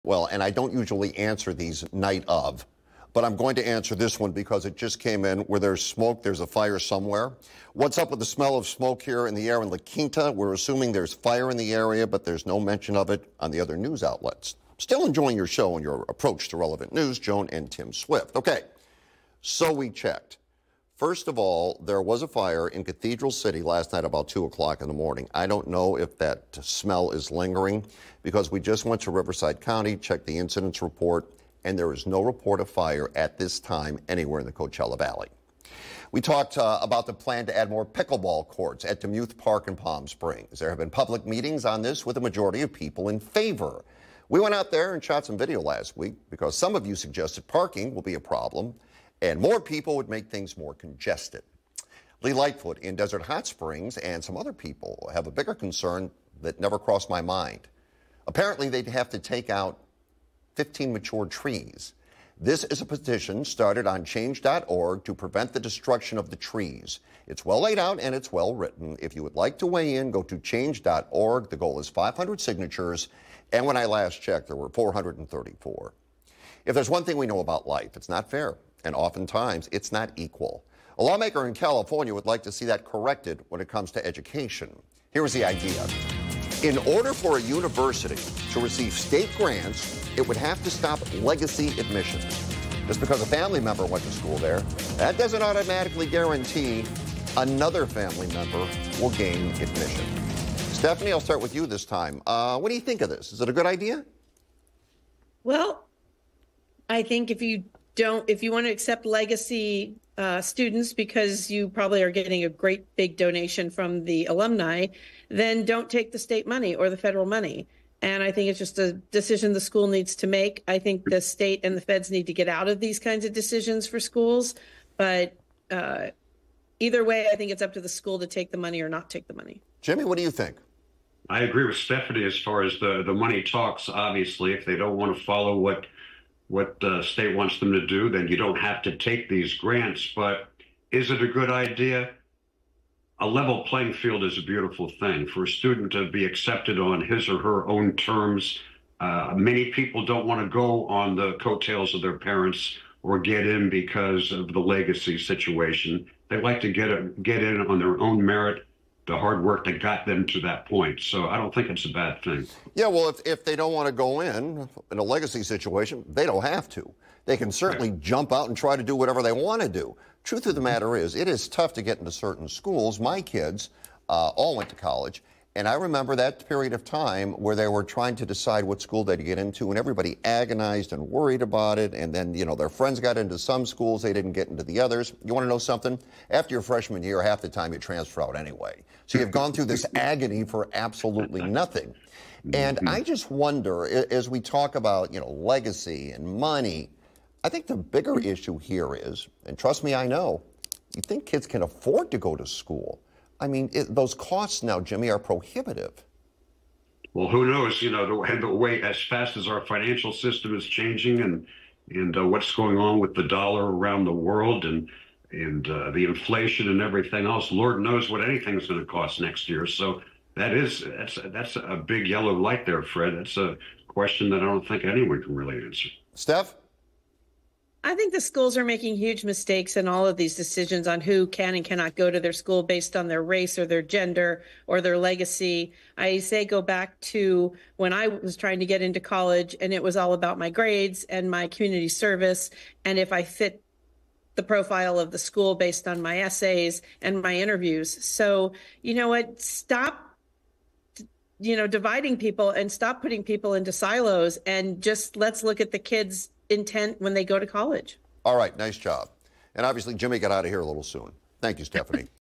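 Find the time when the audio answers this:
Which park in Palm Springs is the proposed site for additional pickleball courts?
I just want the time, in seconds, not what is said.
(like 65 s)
39 s.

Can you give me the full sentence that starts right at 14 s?
Still enjoying your show and your approach to relevant news, Joan and Tim Swift.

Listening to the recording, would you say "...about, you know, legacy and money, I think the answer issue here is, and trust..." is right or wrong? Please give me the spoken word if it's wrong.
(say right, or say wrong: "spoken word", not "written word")
wrong: "bigger", not "answer".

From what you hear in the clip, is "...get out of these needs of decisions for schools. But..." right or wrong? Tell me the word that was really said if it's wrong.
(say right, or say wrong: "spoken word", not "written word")
wrong: "kinds", not "needs".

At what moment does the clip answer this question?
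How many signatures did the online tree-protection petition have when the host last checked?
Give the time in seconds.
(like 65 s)
74 s.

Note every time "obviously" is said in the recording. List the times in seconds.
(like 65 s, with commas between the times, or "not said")
133 s, 259 s.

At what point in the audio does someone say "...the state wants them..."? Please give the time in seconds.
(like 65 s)
136 s.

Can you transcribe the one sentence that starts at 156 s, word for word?
They like to get a, get in on their own merit the hard work that got them to that point.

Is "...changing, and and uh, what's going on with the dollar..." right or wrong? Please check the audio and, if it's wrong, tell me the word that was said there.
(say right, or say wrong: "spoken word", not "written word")
right.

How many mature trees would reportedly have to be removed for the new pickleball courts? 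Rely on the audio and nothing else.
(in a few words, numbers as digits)
15.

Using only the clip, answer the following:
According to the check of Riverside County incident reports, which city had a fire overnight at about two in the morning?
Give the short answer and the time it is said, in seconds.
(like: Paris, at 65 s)
Cathedral City, at 22 s.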